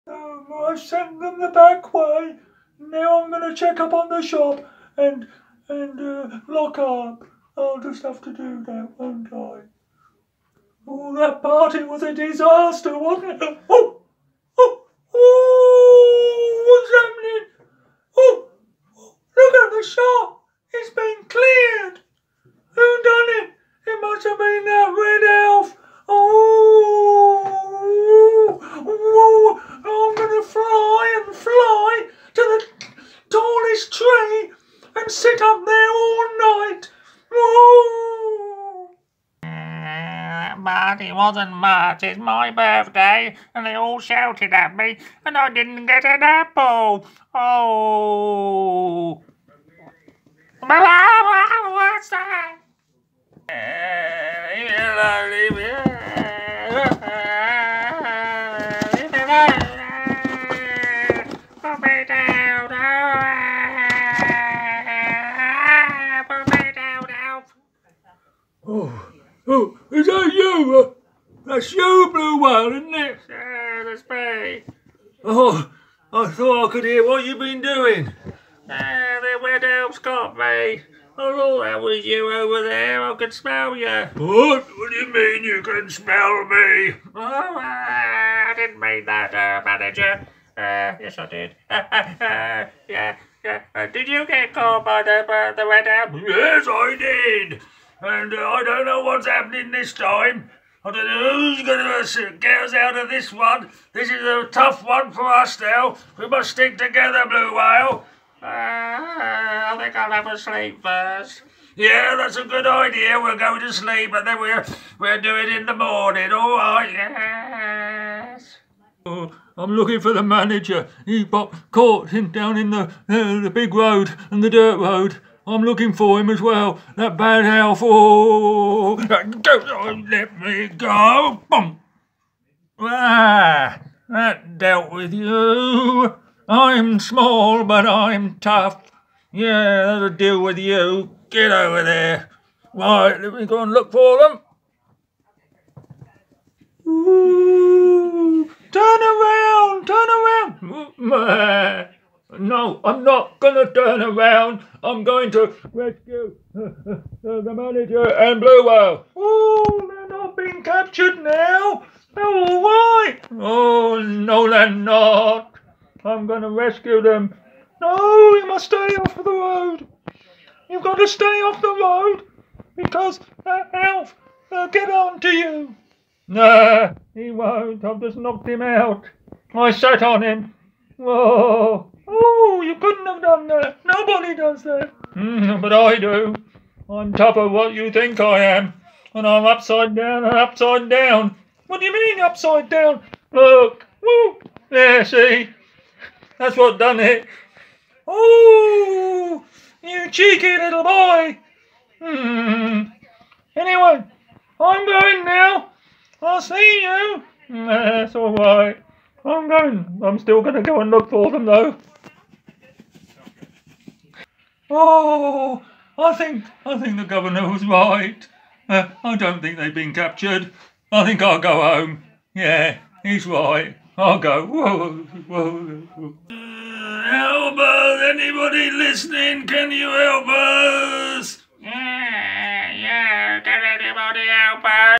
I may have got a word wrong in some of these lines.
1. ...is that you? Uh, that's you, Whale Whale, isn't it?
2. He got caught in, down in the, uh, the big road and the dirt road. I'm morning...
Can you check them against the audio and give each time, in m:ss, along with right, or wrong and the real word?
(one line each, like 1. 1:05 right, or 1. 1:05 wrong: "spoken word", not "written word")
1. 1:10 wrong: "Blue", not "Whale"
2. 2:01 wrong: "looking", not "morning".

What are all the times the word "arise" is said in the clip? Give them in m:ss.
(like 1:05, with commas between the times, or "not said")
not said.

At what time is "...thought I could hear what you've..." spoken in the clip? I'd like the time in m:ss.
1:16.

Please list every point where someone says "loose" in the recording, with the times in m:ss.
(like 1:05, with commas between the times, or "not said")
not said.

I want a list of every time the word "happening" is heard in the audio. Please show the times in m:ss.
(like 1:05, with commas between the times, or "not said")
0:16, 1:39.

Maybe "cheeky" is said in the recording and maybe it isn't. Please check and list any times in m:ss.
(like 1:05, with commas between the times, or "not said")
3:20.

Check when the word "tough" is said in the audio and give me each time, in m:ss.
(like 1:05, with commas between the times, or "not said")
1:44, 2:18.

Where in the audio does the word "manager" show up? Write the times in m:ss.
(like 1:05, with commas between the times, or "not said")
1:29, 2:00, 2:37.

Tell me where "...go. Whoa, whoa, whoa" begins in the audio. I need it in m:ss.
3:44.